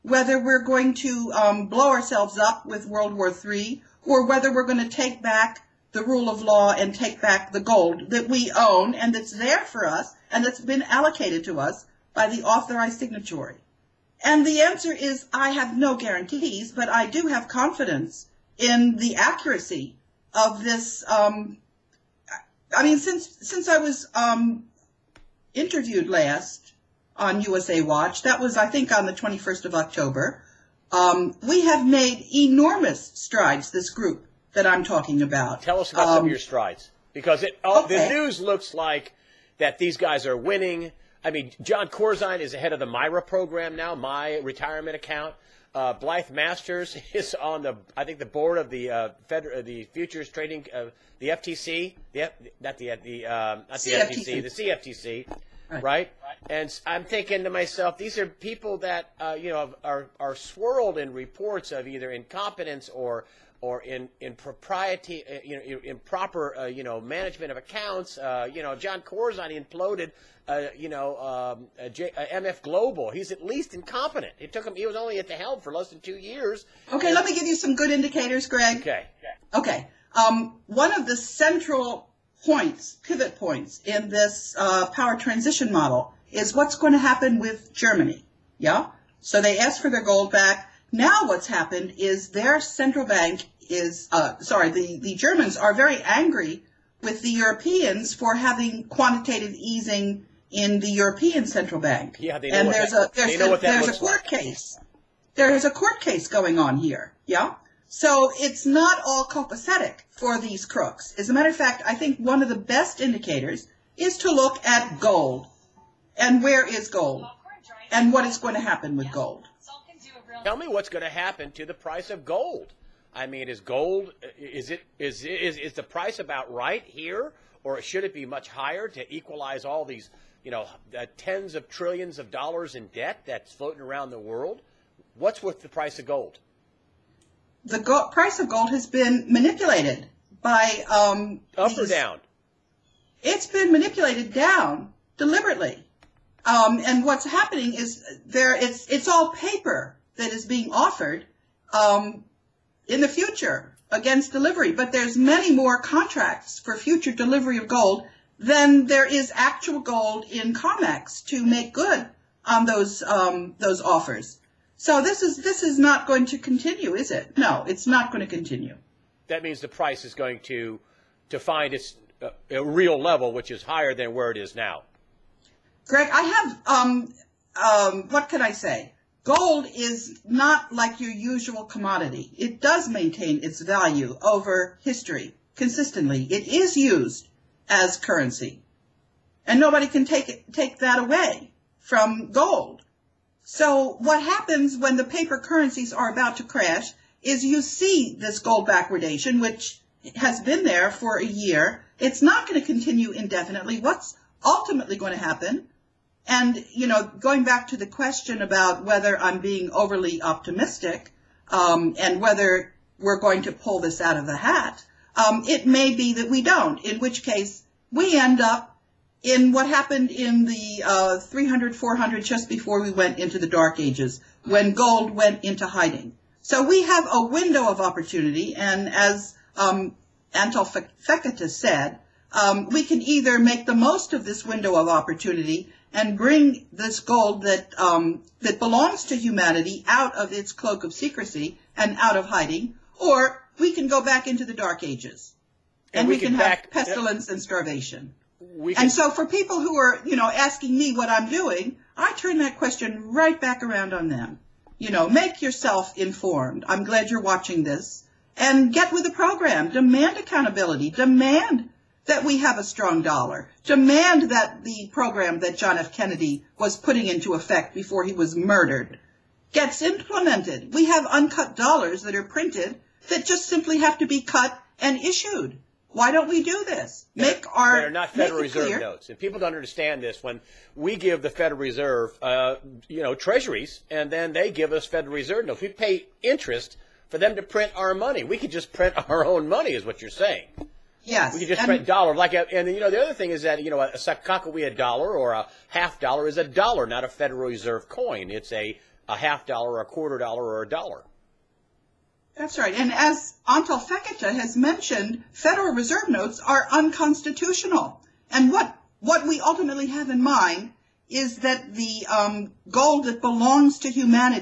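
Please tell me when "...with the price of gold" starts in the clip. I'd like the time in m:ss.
2:15.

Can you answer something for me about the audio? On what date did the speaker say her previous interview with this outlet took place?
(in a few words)
21st of October.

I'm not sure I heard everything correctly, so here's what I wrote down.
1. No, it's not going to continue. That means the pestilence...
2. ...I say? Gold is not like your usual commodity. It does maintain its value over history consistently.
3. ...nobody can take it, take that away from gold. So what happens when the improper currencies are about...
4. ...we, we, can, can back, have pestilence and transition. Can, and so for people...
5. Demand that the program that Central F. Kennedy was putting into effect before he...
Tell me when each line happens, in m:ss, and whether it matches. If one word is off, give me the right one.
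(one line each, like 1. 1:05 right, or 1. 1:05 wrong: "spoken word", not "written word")
1. 2:47 wrong: "price", not "pestilence"
2. 2:58 right
3. 3:09 wrong: "paper", not "improper"
4. 4:06 wrong: "starvation", not "transition"
5. 4:23 wrong: "John", not "Central".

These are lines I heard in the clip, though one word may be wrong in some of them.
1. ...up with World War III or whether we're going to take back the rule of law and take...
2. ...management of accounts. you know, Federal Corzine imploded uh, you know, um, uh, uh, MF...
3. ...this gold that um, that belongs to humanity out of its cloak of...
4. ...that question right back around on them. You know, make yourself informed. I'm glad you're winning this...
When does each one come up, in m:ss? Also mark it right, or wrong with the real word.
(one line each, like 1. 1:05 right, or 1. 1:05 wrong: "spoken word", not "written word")
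1. 0:02 right
2. 1:06 wrong: "Jon", not "Federal"
3. 3:56 right
4. 4:12 wrong: "watching", not "winning".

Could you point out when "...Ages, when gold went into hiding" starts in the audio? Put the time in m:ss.
3:43.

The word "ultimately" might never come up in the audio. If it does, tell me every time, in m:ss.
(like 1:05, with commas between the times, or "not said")
3:24, 5:09.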